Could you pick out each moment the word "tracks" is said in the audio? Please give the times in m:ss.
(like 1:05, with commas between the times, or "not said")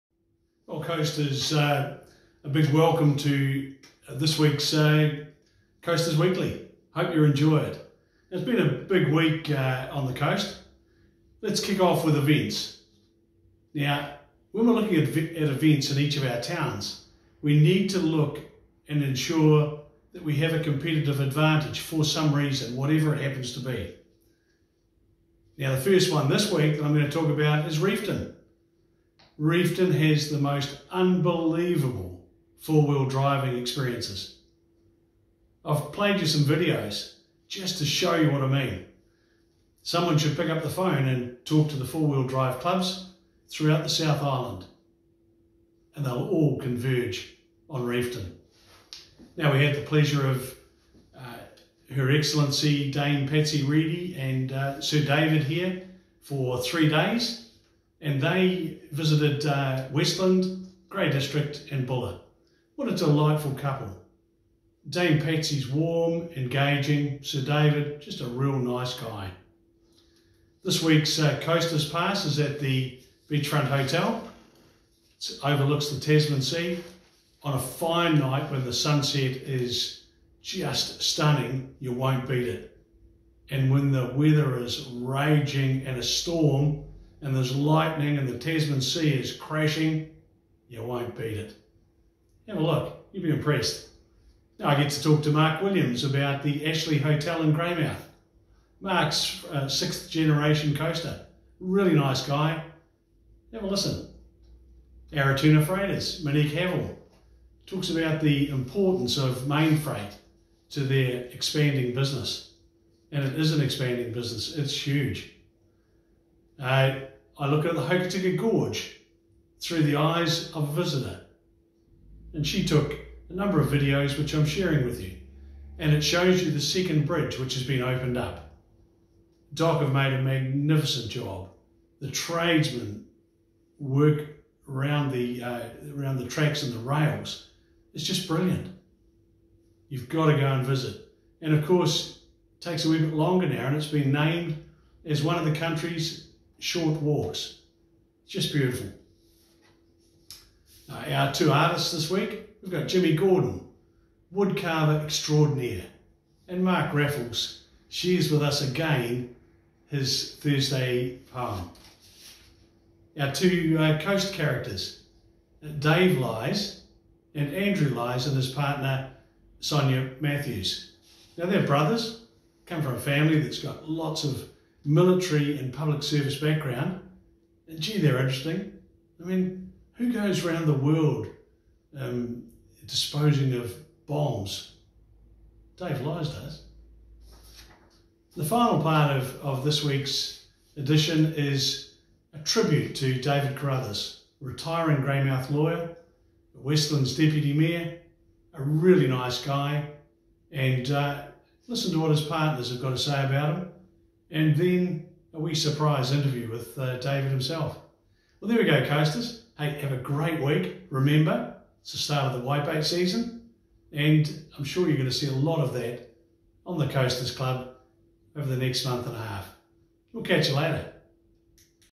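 2:16.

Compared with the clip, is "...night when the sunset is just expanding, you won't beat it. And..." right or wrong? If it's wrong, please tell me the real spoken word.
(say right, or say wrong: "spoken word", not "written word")
wrong: "stunning", not "expanding".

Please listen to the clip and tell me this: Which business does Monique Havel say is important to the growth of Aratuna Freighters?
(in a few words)
Mainfreight.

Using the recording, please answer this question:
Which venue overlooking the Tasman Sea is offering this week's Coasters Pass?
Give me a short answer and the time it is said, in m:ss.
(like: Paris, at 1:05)
Beachfront Hotel, at 1:13.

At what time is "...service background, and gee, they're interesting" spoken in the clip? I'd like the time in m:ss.
2:56.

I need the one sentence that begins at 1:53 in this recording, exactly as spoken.
And it is an expanding business, it's huge.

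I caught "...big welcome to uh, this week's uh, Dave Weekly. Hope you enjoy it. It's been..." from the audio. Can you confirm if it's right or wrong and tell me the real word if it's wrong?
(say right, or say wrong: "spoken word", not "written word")
wrong: "Coasters", not "Dave".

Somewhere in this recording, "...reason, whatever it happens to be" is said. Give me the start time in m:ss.
0:22.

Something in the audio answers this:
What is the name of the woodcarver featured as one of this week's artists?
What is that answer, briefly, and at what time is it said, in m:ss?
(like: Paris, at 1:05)
Jimmy Gordon, at 2:32.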